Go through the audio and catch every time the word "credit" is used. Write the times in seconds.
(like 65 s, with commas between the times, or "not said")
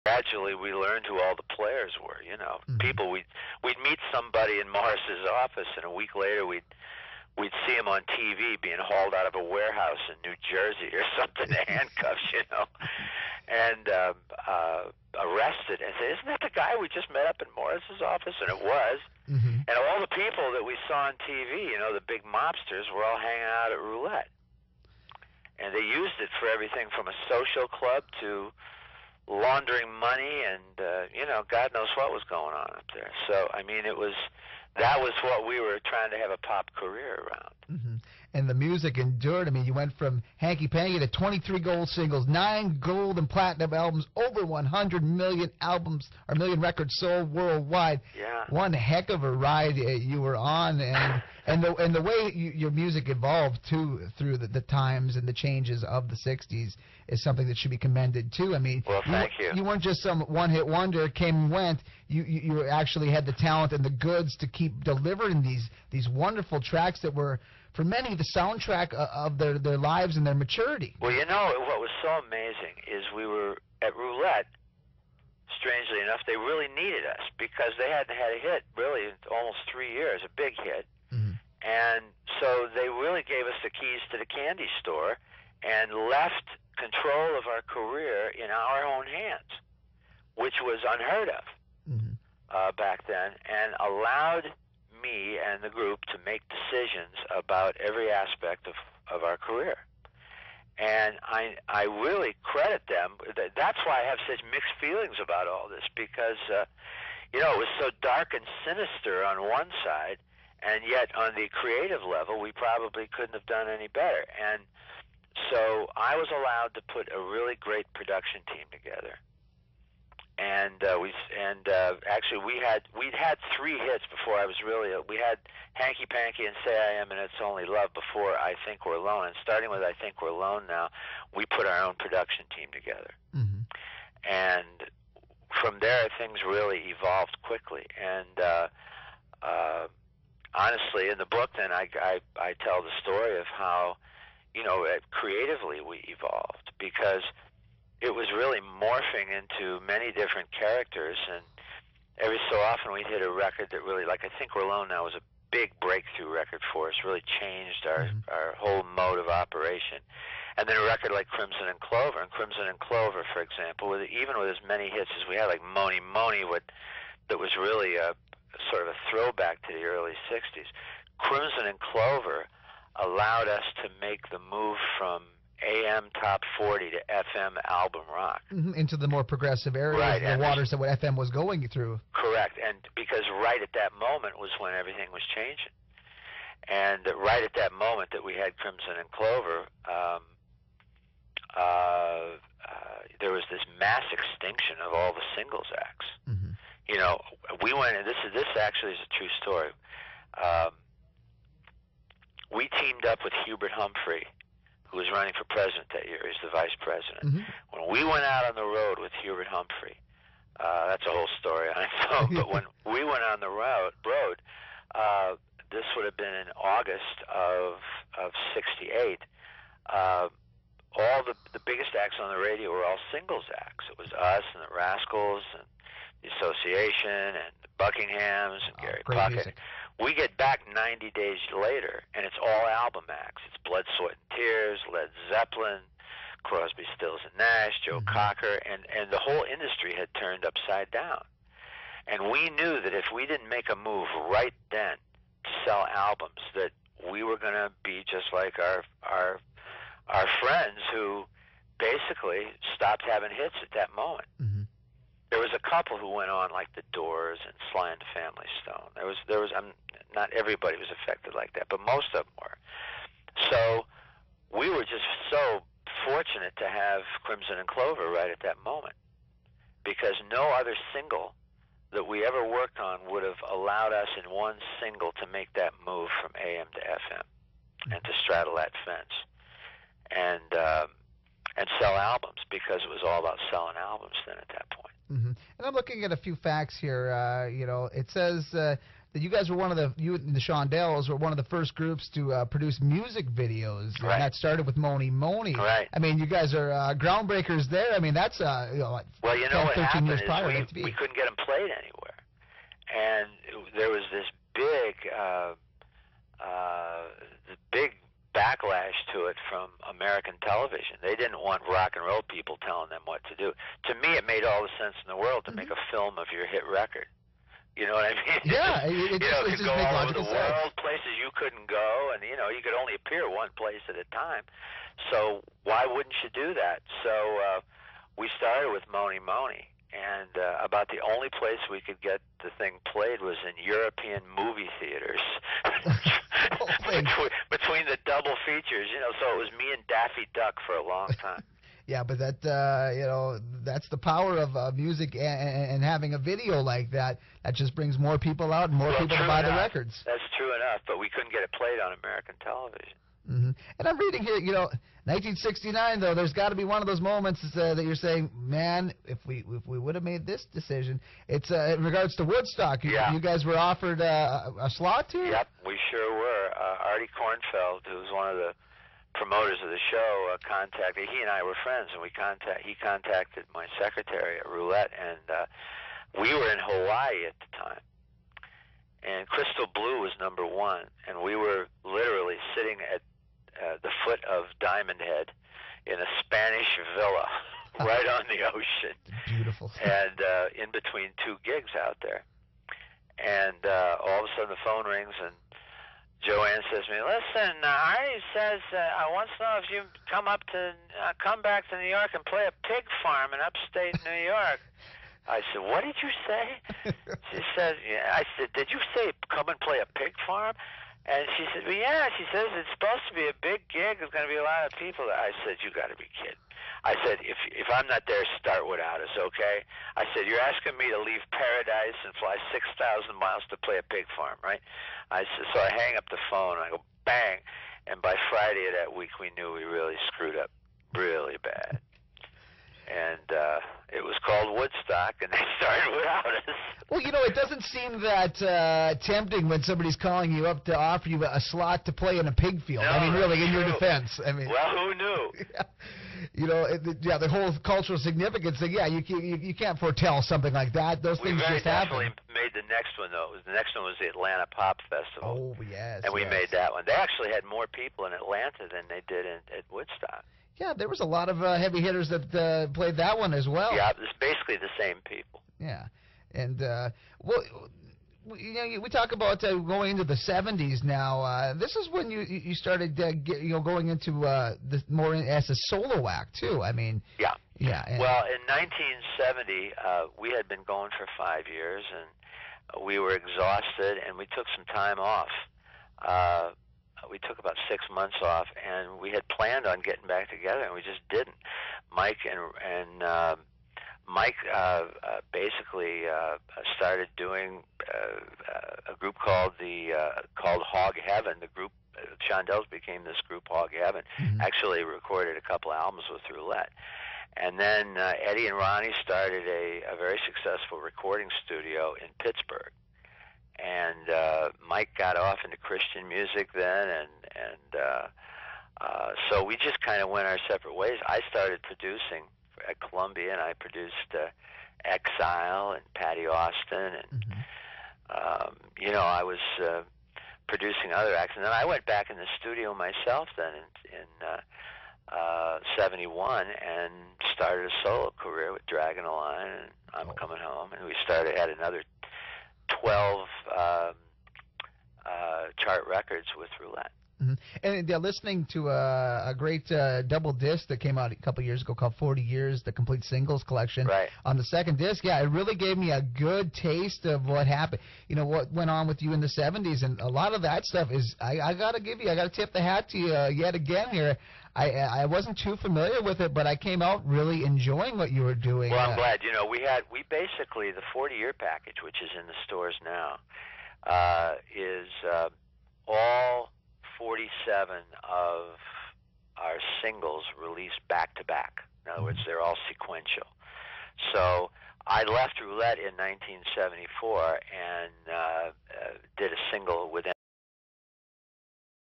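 102 s.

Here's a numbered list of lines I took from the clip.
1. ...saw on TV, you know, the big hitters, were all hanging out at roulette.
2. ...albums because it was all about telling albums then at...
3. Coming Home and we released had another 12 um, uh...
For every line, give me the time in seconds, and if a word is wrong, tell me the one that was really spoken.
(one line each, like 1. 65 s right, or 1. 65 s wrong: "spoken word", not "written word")
1. 20 s wrong: "mobsters", not "hitters"
2. 281 s wrong: "selling", not "telling"
3. 540 s wrong: "started", not "released".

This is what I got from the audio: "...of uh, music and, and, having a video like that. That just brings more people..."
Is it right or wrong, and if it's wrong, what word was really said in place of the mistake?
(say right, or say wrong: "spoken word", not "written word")
right.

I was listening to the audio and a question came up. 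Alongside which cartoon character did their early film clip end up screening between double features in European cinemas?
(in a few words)
Daffy Duck.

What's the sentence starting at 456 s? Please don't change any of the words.
They actually had more people in Atlanta than they did in, at Woodstock.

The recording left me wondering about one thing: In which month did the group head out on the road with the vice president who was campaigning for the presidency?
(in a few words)
August.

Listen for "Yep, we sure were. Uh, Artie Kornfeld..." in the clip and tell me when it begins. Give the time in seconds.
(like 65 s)
365 s.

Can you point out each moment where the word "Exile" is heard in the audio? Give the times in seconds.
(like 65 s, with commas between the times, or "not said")
524 s.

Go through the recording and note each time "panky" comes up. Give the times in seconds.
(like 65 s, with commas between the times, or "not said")
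40 s, 126 s.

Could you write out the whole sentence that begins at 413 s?
There's going to be a lot of people.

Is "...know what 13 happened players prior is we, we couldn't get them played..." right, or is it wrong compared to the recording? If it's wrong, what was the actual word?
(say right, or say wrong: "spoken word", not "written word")
wrong: "years", not "players".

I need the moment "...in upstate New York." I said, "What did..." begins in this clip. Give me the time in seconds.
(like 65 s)
403 s.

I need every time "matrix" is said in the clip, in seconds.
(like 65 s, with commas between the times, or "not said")
not said.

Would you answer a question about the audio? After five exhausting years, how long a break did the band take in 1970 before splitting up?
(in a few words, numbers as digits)
6 months.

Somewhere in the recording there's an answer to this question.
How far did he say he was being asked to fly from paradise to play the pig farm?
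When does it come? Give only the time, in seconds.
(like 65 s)
422 s.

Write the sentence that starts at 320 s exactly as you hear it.
world, places you couldn't go, and you know you could only appear one place at a time.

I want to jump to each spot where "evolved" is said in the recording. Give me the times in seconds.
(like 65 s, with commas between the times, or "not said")
53 s, 136 s, 146 s.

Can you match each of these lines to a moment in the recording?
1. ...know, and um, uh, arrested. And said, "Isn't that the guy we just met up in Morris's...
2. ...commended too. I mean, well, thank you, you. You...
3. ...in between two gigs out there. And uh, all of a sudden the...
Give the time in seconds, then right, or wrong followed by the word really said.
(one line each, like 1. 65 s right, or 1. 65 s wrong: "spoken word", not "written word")
1. 12 s right
2. 57 s right
3. 390 s right.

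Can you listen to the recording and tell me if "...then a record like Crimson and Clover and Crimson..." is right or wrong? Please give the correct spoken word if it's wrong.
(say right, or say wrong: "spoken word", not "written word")
right.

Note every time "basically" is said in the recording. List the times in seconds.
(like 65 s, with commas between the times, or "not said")
251 s, 464 s, 495 s, 570 s.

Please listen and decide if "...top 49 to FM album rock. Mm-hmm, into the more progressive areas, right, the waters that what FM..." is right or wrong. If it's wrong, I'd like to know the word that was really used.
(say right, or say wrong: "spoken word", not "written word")
wrong: "40", not "49".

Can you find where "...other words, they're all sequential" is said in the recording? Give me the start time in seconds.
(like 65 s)
581 s.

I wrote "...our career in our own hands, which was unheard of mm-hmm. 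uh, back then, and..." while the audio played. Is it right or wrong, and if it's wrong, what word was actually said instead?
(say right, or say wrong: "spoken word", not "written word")
right.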